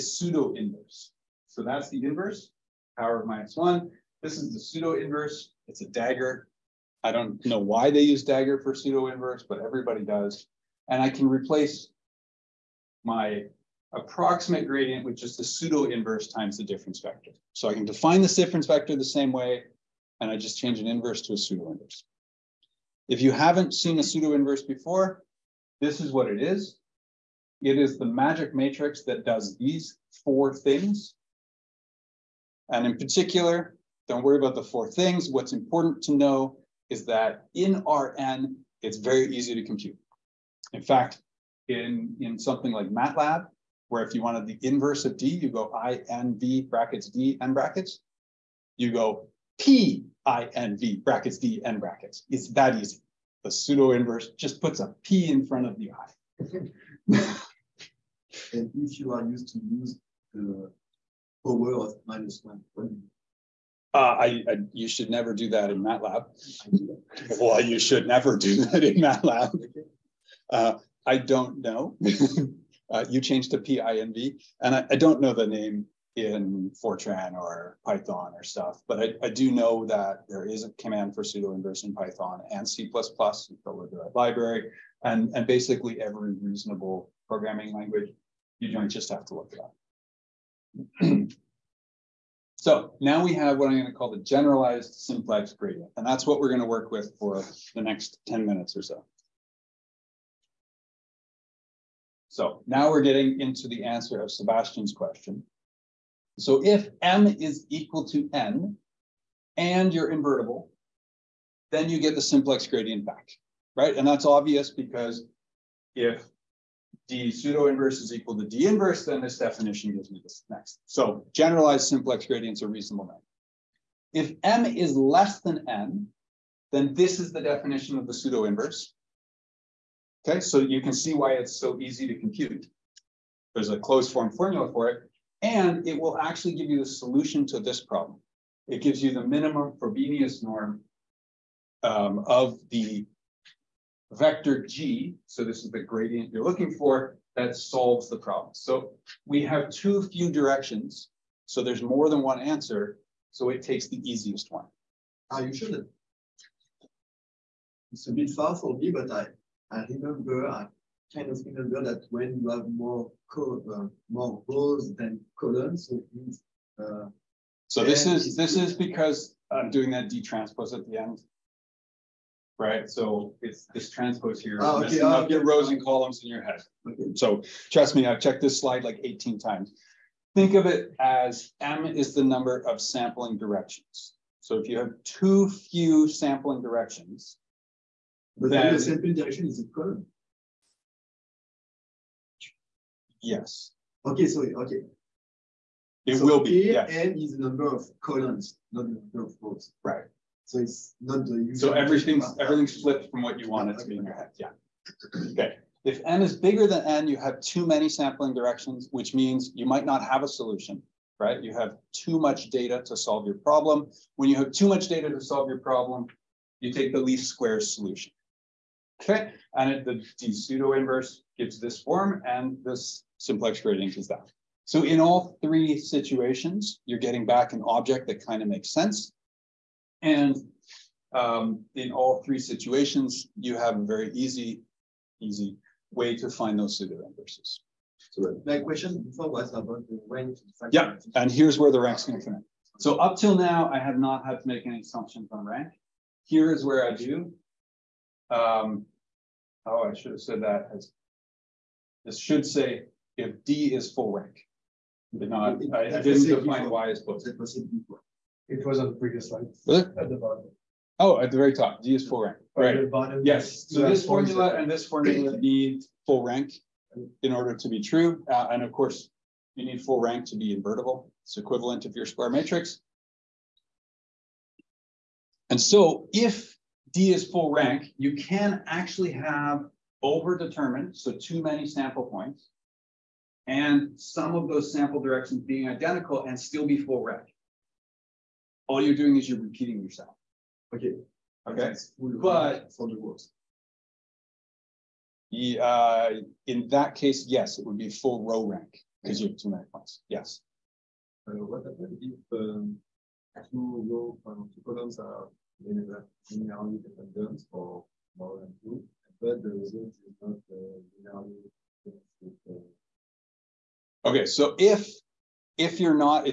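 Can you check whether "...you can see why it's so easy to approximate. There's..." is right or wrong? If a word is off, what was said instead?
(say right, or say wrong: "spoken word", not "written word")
wrong: "compute", not "approximate".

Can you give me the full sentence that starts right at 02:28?
So we have too few directions, so there's more than one answer, so it takes the easiest one.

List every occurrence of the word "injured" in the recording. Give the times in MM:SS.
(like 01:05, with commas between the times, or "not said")
not said.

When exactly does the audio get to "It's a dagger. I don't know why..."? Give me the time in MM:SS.
00:05.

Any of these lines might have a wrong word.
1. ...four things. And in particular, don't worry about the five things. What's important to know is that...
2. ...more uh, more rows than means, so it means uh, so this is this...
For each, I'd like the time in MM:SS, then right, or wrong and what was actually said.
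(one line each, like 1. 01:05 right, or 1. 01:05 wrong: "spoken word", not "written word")
1. 00:30 wrong: "four", not "five"
2. 02:42 wrong: "columns", not "means".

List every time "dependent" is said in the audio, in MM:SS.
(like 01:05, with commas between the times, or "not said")
05:06, 05:11.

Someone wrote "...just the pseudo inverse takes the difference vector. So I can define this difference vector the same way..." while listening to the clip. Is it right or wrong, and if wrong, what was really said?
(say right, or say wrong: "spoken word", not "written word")
wrong: "times", not "takes".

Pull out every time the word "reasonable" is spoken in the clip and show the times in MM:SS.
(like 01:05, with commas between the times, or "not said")
01:26, 02:02.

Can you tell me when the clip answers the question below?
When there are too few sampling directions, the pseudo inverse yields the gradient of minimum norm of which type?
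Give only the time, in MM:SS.
02:19.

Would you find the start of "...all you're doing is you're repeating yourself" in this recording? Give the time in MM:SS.
04:48.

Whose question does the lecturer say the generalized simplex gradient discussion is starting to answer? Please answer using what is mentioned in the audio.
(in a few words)
Sebastian.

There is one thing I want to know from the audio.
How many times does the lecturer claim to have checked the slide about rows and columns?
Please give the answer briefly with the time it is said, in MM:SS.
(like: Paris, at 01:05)
18, at 02:59.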